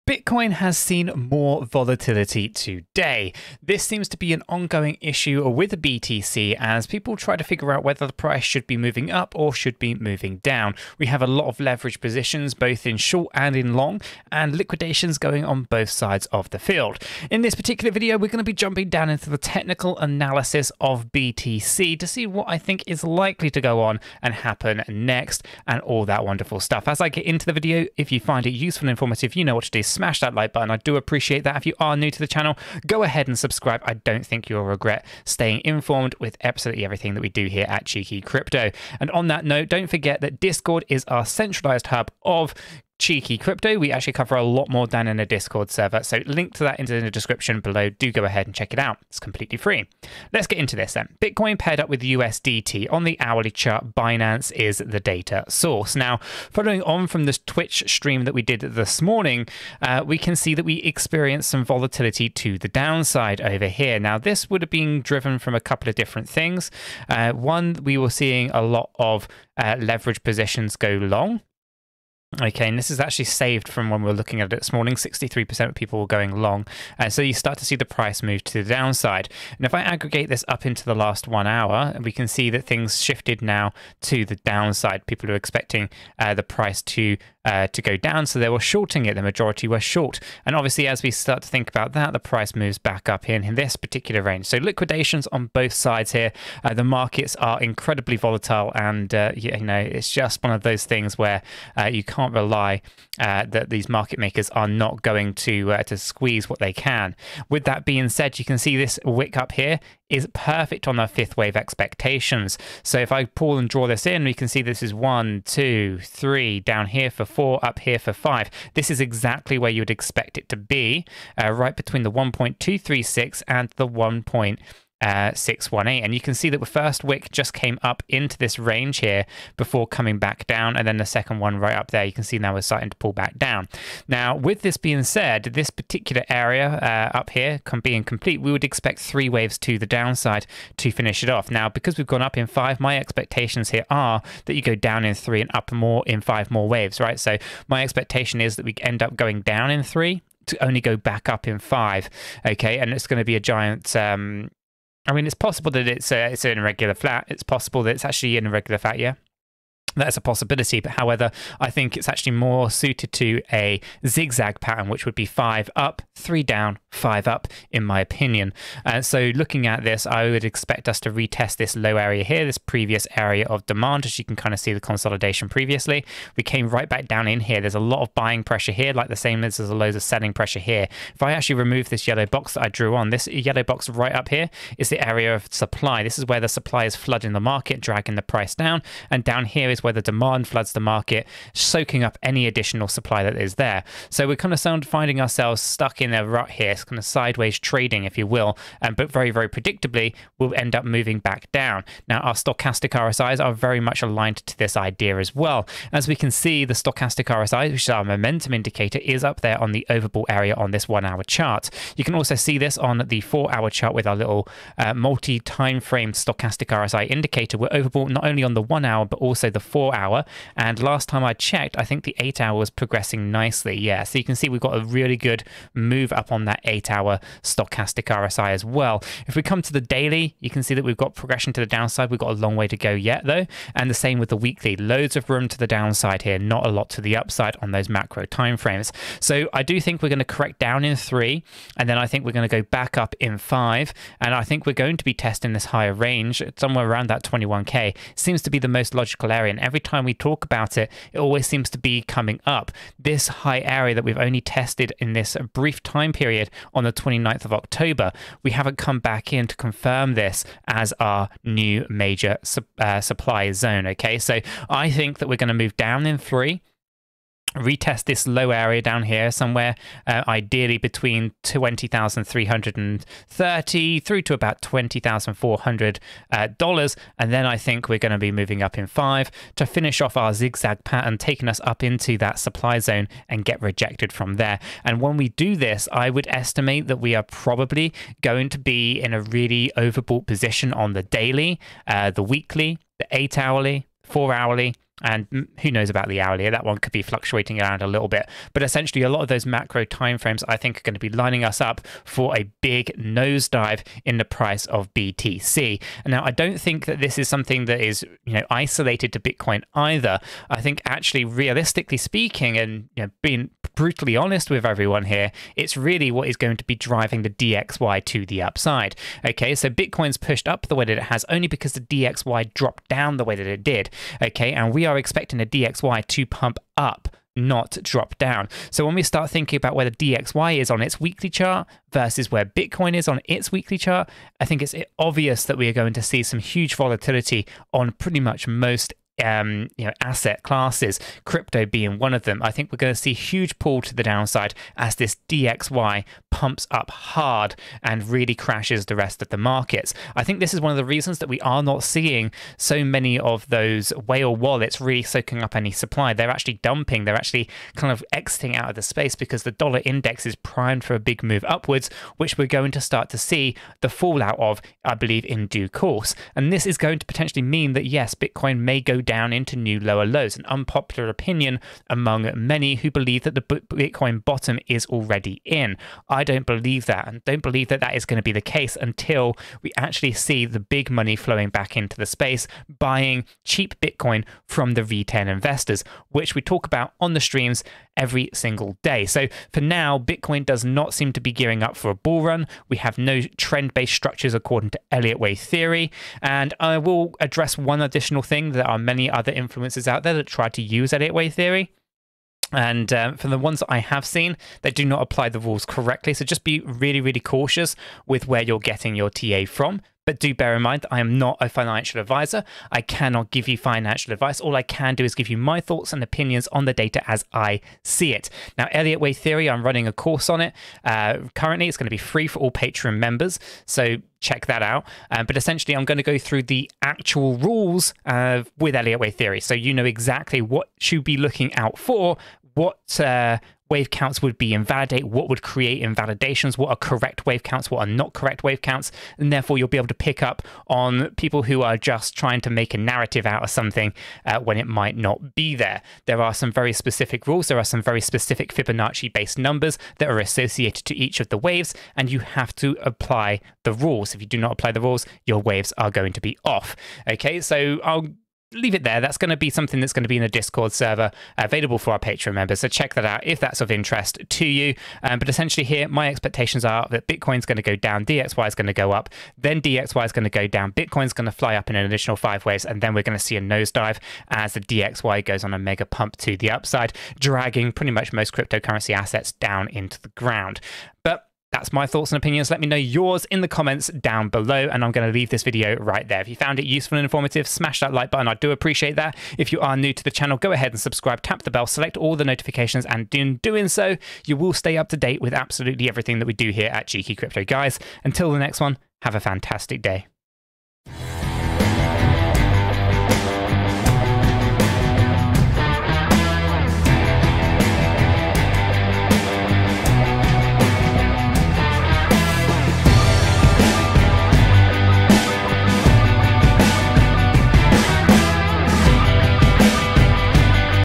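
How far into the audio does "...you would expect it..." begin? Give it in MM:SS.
01:59.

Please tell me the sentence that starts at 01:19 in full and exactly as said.
And if I aggregate this up into the last one hour, we can see that things shifted now to the downside.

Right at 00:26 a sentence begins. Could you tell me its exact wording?
As I get into the video, if you find it useful and informative, you know what to do.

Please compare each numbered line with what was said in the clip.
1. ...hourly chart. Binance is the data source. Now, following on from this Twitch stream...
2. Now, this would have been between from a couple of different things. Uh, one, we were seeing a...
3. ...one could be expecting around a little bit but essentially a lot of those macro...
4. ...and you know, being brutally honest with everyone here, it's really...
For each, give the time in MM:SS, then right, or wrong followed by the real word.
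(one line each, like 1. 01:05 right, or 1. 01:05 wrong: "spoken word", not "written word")
1. 00:53 right
2. 01:03 wrong: "driven", not "between"
3. 04:56 wrong: "fluctuating", not "expecting"
4. 05:12 right.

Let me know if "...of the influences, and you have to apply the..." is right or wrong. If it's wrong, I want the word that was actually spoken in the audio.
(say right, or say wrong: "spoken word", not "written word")
wrong: "waves", not "influences".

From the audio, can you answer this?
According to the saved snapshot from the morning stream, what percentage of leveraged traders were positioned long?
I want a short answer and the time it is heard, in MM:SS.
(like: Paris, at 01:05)
63%, at 01:14.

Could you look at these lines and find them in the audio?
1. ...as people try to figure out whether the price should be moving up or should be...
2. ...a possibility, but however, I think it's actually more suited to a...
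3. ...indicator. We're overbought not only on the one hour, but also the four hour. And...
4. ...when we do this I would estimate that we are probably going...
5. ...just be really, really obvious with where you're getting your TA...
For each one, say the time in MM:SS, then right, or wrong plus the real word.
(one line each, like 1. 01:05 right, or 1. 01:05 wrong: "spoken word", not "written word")
1. 00:06 right
2. 02:40 right
3. 03:37 right
4. 04:45 right
5. 06:46 wrong: "cautious", not "obvious".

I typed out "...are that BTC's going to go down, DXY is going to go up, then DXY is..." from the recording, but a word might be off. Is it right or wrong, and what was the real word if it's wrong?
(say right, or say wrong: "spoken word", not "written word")
wrong: "Bitcoin", not "BTC".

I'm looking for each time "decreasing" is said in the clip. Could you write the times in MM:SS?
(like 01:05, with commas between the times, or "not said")
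not said.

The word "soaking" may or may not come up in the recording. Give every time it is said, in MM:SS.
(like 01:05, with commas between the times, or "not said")
03:11, 05:55.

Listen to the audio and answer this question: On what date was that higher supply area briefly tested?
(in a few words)
29th of October.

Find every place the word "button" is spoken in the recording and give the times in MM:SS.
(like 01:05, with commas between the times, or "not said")
00:30, 08:08.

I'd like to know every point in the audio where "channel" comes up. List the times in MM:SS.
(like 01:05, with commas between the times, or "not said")
00:32, 08:10.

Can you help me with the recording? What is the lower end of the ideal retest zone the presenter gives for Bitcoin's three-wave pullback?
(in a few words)
20,330.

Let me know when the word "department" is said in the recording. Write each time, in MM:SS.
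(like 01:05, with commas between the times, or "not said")
not said.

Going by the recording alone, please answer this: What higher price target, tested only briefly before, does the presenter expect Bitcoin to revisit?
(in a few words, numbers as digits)
21K.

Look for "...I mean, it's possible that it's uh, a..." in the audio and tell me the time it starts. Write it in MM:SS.
02:35.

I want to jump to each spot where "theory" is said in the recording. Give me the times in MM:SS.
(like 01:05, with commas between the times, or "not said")
06:35, 06:41, 06:59, 07:09.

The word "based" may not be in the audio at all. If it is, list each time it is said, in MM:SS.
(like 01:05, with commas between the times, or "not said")
06:33, 07:29.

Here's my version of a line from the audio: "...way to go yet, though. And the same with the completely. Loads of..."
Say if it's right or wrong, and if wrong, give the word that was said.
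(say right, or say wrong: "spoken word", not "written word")
wrong: "weekly", not "completely".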